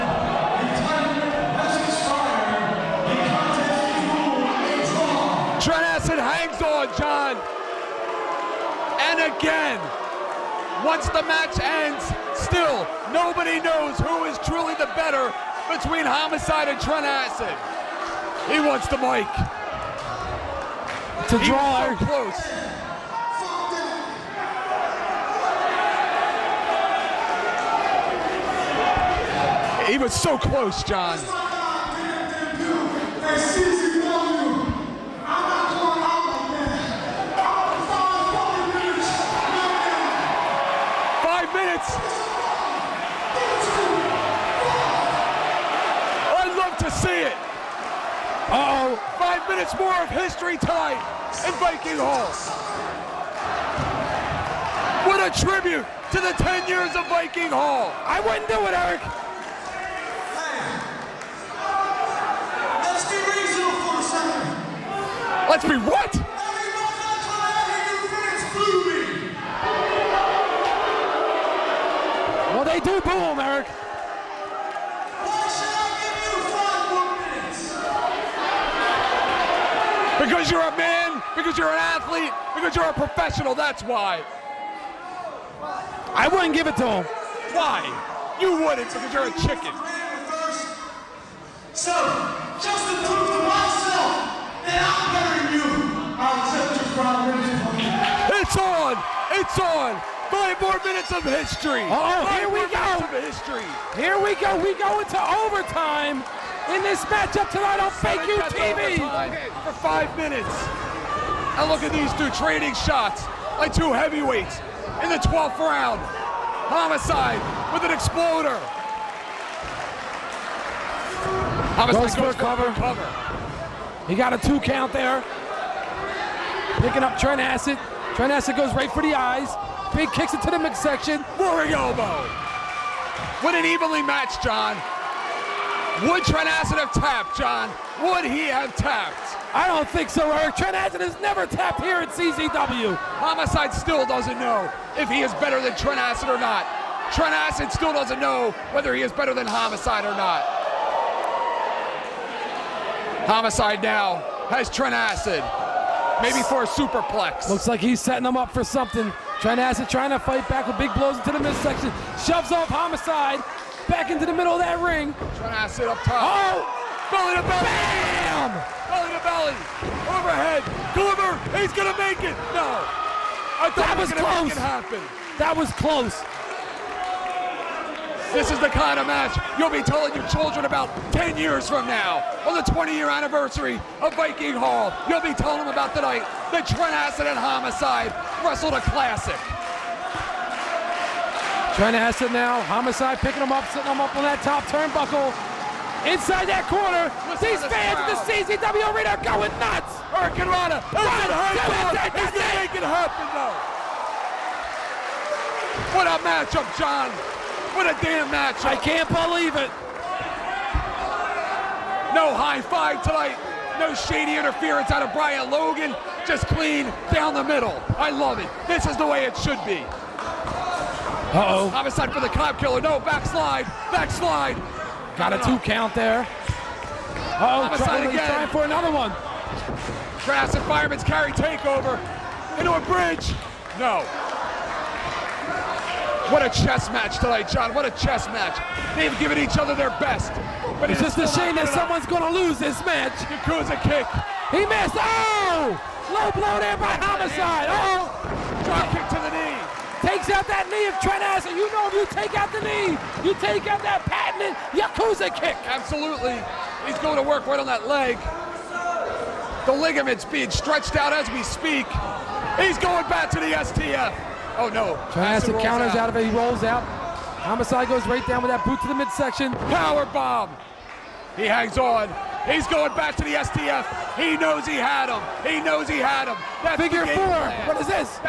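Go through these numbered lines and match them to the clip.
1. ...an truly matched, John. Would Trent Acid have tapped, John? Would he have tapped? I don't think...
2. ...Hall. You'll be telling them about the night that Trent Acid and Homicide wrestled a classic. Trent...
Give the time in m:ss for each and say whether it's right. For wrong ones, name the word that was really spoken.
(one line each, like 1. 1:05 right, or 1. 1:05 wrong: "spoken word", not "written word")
1. 2:13 wrong: "evenly", not "truly"
2. 3:04 right.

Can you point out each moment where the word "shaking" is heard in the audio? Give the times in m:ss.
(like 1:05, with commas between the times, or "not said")
not said.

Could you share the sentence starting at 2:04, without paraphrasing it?
He got a two count there.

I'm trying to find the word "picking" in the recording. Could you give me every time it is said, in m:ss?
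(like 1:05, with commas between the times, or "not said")
2:06, 3:13.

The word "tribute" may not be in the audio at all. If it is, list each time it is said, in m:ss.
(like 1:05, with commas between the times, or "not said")
0:55.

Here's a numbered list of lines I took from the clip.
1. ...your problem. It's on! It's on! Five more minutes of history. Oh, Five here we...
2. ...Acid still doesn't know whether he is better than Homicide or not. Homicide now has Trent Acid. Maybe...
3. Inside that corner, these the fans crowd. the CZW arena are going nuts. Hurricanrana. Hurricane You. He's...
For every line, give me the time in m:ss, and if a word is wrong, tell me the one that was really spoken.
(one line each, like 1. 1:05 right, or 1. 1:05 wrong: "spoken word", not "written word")
1. 1:36 right
2. 2:27 right
3. 3:16 wrong: "Rana", not "You".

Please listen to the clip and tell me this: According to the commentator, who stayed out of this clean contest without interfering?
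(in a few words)
Brian Logan.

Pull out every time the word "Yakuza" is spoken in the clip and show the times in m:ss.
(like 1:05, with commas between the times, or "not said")
4:03, 4:14.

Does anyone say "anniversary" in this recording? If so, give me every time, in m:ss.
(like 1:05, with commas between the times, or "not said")
3:03.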